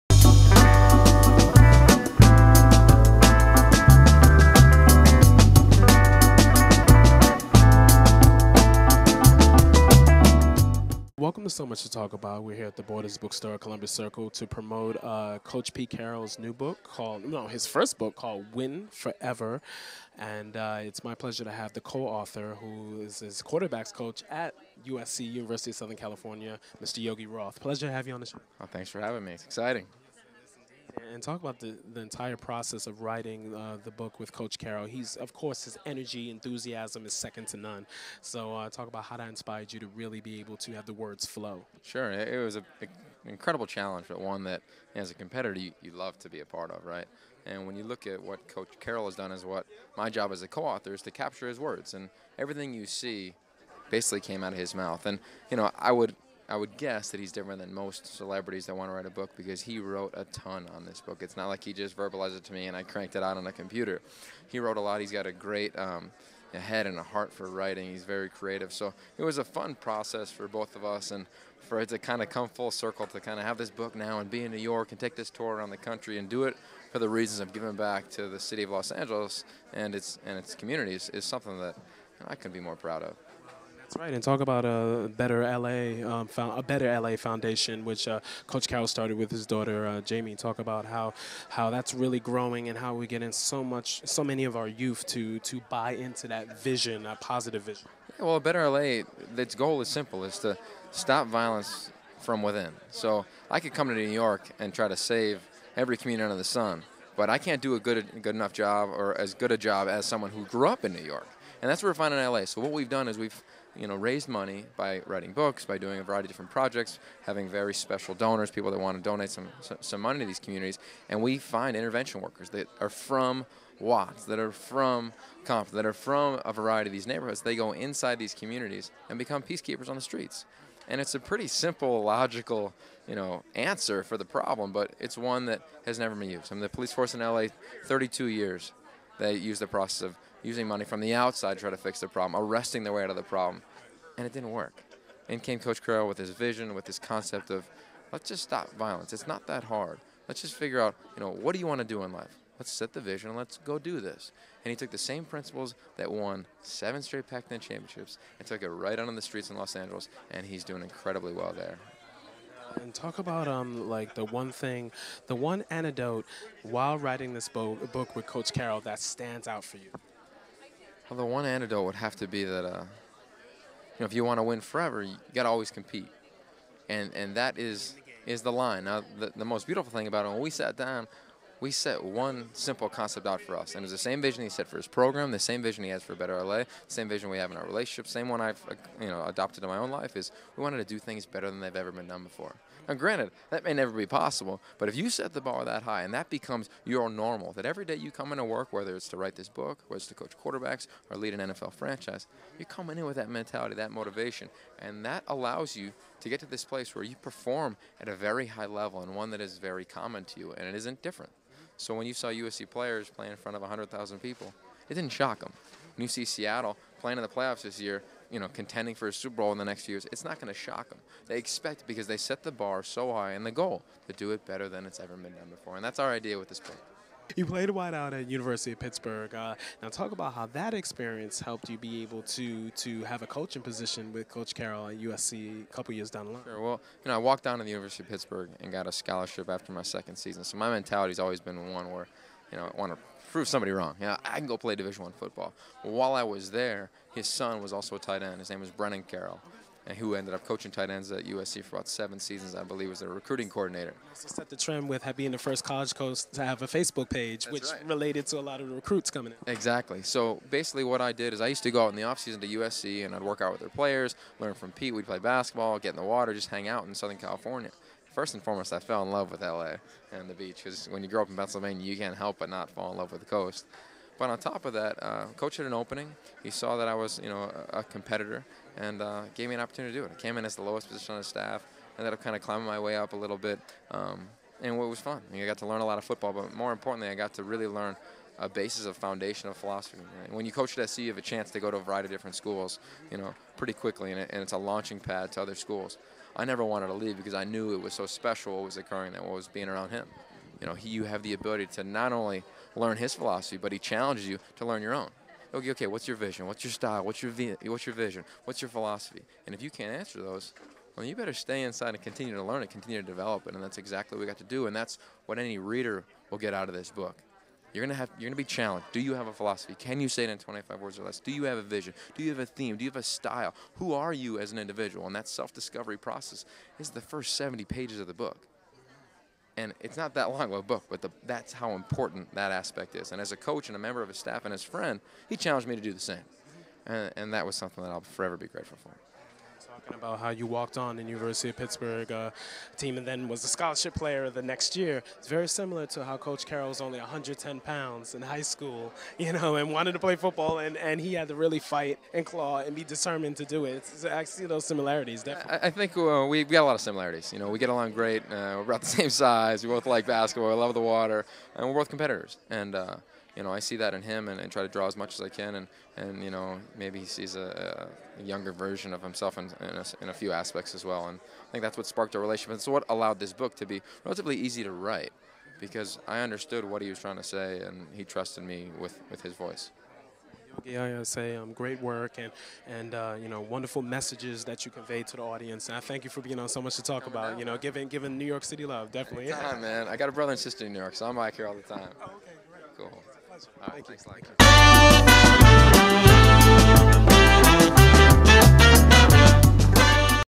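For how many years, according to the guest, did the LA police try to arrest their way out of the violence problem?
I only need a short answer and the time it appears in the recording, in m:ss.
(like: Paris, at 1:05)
32, at 2:17.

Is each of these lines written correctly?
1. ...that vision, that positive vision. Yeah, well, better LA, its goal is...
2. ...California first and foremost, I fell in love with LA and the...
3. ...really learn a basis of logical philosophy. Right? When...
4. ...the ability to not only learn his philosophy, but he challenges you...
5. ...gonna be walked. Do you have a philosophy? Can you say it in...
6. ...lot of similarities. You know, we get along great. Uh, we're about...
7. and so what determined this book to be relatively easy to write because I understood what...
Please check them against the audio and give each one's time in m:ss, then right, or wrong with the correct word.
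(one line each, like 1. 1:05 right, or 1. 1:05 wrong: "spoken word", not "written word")
1. 1:36 right
2. 4:27 right
3. 4:47 wrong: "foundational", not "logical"
4. 5:01 right
5. 5:18 wrong: "challenged", not "walked"
6. 5:56 right
7. 6:12 wrong: "allowed", not "determined".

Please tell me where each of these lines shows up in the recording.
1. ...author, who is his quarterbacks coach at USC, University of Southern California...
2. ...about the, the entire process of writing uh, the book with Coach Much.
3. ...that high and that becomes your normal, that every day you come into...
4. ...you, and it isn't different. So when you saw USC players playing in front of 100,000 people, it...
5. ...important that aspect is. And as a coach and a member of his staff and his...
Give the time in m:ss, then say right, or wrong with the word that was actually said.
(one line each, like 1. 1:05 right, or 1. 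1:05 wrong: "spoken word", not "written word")
1. 0:22 right
2. 0:31 wrong: "Carroll", not "Much"
3. 3:15 right
4. 3:30 right
5. 5:31 right.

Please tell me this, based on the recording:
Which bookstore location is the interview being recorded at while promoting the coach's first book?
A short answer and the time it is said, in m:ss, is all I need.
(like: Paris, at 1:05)
Columbus Circle, at 0:13.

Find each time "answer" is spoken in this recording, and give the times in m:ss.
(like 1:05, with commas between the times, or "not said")
2:13, 5:09.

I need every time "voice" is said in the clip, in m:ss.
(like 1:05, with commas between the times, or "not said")
6:19.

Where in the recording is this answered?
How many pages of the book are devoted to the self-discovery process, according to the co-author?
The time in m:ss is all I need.
5:27.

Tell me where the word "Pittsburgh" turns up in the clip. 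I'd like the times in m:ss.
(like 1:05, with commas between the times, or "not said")
3:48, 3:58, 5:41.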